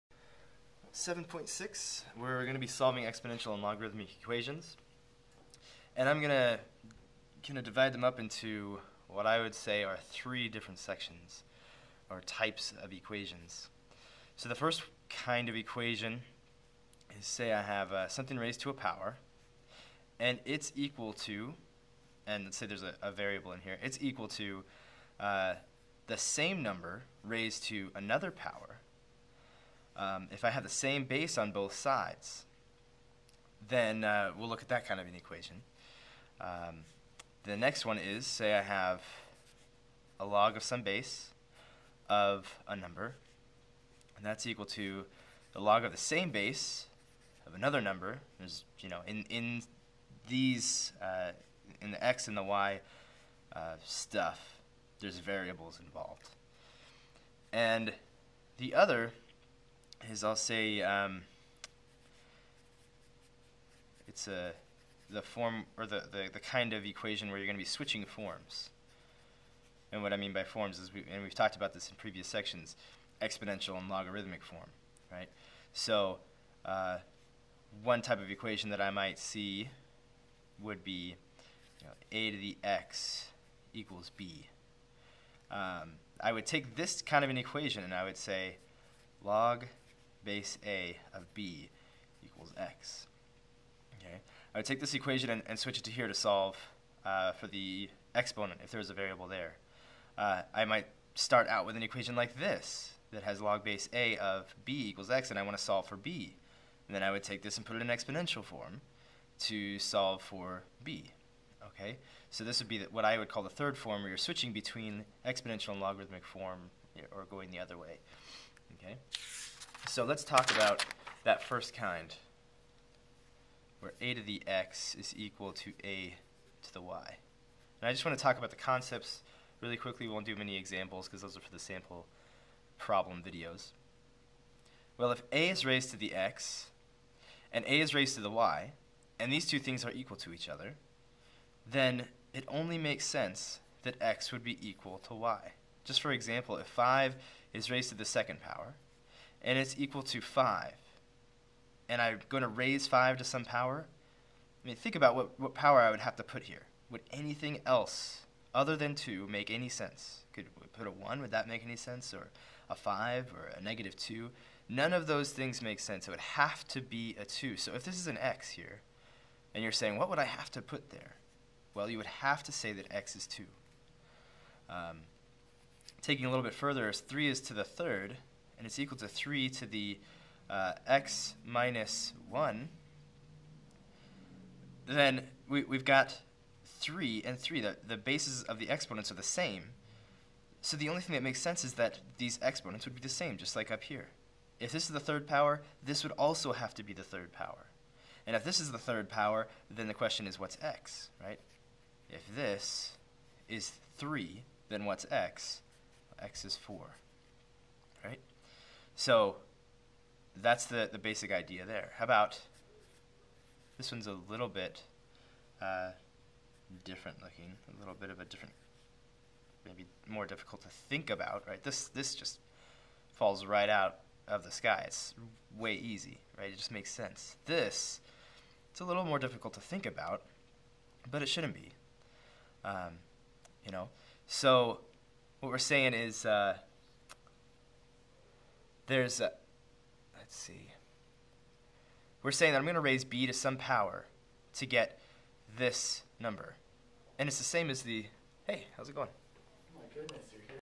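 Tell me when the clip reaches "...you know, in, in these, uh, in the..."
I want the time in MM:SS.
00:48.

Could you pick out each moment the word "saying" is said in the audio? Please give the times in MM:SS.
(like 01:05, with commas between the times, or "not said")
02:49, 03:55, 04:02.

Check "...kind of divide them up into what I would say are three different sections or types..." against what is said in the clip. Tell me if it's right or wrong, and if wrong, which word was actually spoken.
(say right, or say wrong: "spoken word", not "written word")
right.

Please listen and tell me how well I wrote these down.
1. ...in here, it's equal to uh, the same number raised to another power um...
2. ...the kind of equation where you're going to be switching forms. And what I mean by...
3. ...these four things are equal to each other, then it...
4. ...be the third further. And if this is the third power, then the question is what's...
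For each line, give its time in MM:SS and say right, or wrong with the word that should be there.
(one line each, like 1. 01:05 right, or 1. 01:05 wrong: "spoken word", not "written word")
1. 00:23 right
2. 01:06 right
3. 02:19 wrong: "two", not "four"
4. 03:16 wrong: "power", not "further".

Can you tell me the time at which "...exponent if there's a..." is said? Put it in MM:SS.
01:38.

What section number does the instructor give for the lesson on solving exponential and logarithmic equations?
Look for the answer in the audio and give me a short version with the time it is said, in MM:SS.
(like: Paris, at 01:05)
7.6, at 00:00.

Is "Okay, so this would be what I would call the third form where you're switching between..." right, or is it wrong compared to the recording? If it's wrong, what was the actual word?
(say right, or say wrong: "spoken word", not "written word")
right.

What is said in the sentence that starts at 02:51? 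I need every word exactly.
Well, you would have to say that x is 2.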